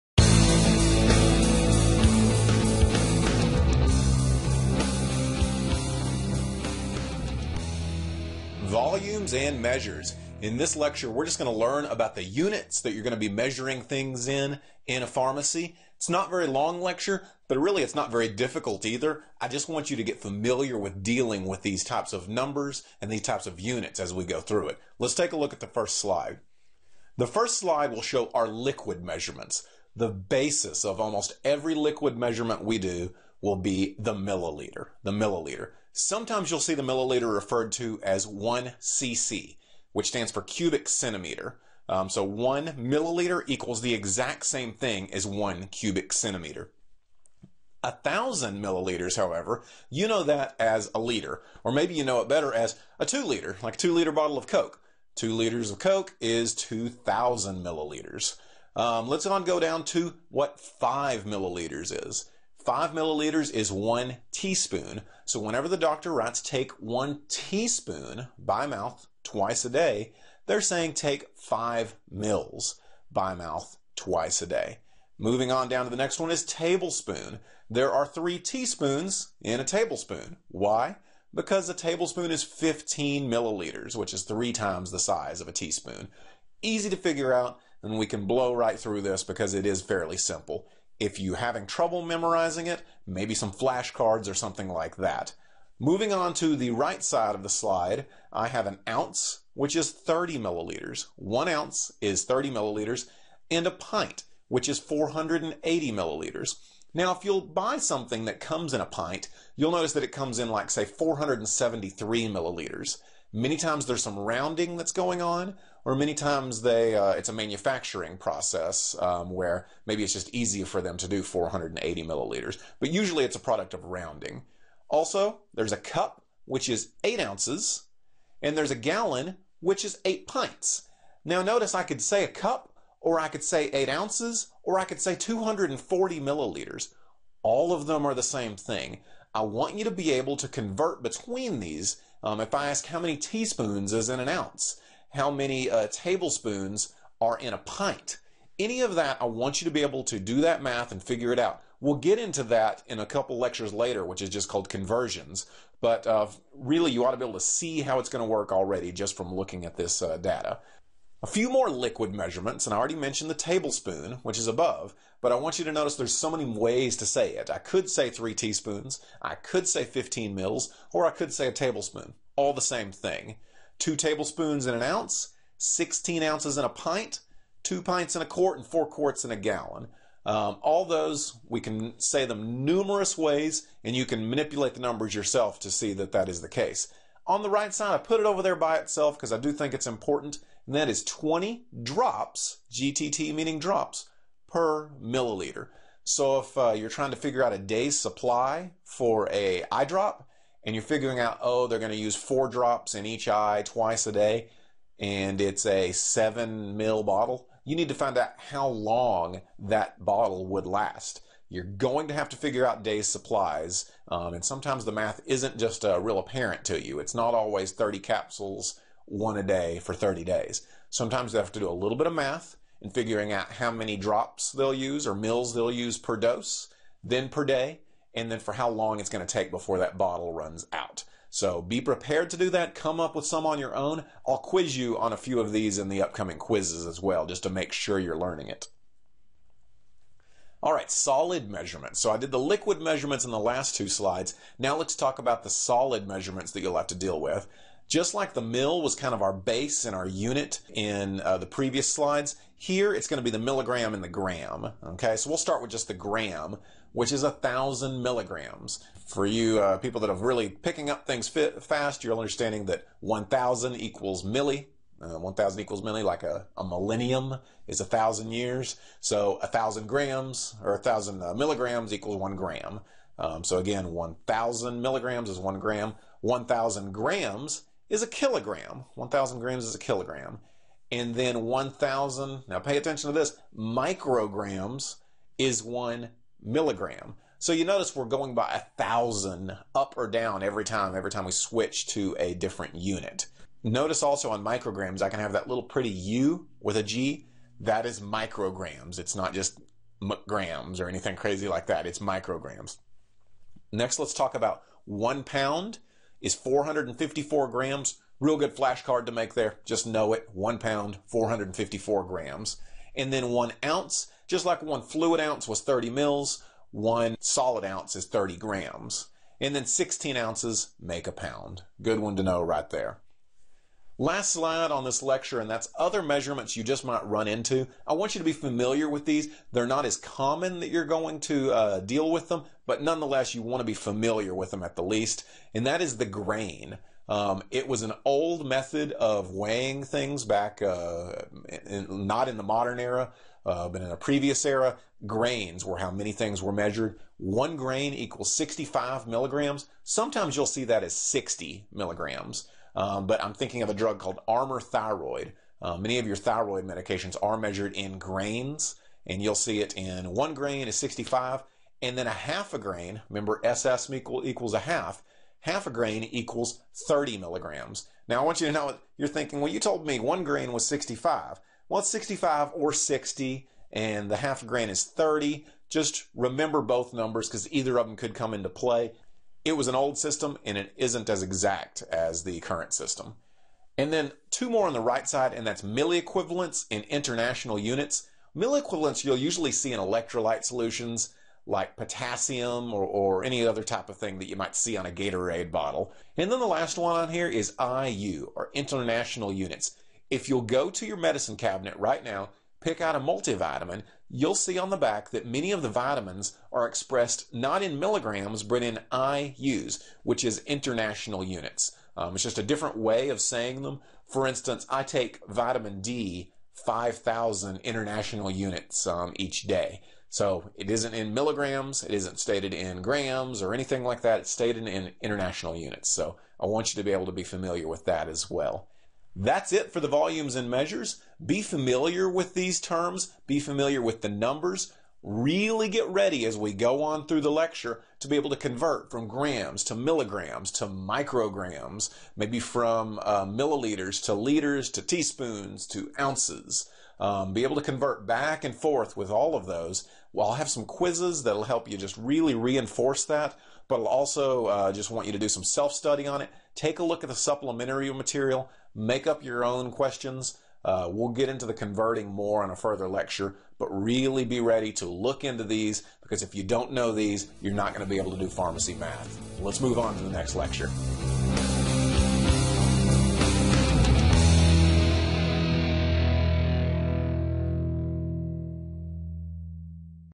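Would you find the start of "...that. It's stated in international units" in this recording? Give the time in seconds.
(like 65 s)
424 s.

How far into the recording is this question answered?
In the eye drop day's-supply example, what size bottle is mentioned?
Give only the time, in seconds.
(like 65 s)
205 s.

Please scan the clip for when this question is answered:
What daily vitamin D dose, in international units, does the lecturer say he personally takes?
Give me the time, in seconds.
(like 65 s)
416 s.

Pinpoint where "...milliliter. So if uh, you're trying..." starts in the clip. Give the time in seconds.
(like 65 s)
195 s.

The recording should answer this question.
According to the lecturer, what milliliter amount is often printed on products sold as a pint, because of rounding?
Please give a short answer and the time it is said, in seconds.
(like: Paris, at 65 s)
473 milliliters, at 110 s.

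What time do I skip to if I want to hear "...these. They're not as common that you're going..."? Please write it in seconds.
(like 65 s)
329 s.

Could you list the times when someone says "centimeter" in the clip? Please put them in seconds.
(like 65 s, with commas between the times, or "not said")
40 s, 46 s.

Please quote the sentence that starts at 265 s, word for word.
Uh, 1,000 equals milli, like a, a millennium is a thousand years.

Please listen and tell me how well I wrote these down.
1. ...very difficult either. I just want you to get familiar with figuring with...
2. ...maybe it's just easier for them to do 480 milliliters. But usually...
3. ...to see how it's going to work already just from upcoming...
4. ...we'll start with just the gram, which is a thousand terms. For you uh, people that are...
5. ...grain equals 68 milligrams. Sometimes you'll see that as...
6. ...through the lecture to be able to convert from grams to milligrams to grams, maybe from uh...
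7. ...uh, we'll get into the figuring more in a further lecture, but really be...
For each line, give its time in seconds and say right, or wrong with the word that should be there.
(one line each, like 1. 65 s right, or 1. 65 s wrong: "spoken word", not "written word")
1. 18 s wrong: "dealing", not "figuring"
2. 119 s right
3. 157 s wrong: "looking", not "upcoming"
4. 255 s wrong: "milligrams", not "terms"
5. 347 s wrong: "65", not "68"
6. 437 s wrong: "micrograms", not "grams"
7. 460 s wrong: "converting", not "figuring".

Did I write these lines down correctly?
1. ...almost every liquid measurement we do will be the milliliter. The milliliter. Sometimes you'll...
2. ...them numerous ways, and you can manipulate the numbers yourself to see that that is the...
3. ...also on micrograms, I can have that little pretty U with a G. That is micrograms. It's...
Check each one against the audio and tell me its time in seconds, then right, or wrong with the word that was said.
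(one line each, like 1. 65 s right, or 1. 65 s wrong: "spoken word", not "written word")
1. 31 s right
2. 182 s right
3. 294 s right.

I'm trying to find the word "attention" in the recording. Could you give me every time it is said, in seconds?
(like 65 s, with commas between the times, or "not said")
282 s.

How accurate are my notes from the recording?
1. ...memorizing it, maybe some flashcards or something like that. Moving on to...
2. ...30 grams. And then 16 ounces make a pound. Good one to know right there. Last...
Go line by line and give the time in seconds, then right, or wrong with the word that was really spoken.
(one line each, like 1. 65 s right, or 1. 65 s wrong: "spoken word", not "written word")
1. 92 s right
2. 318 s right.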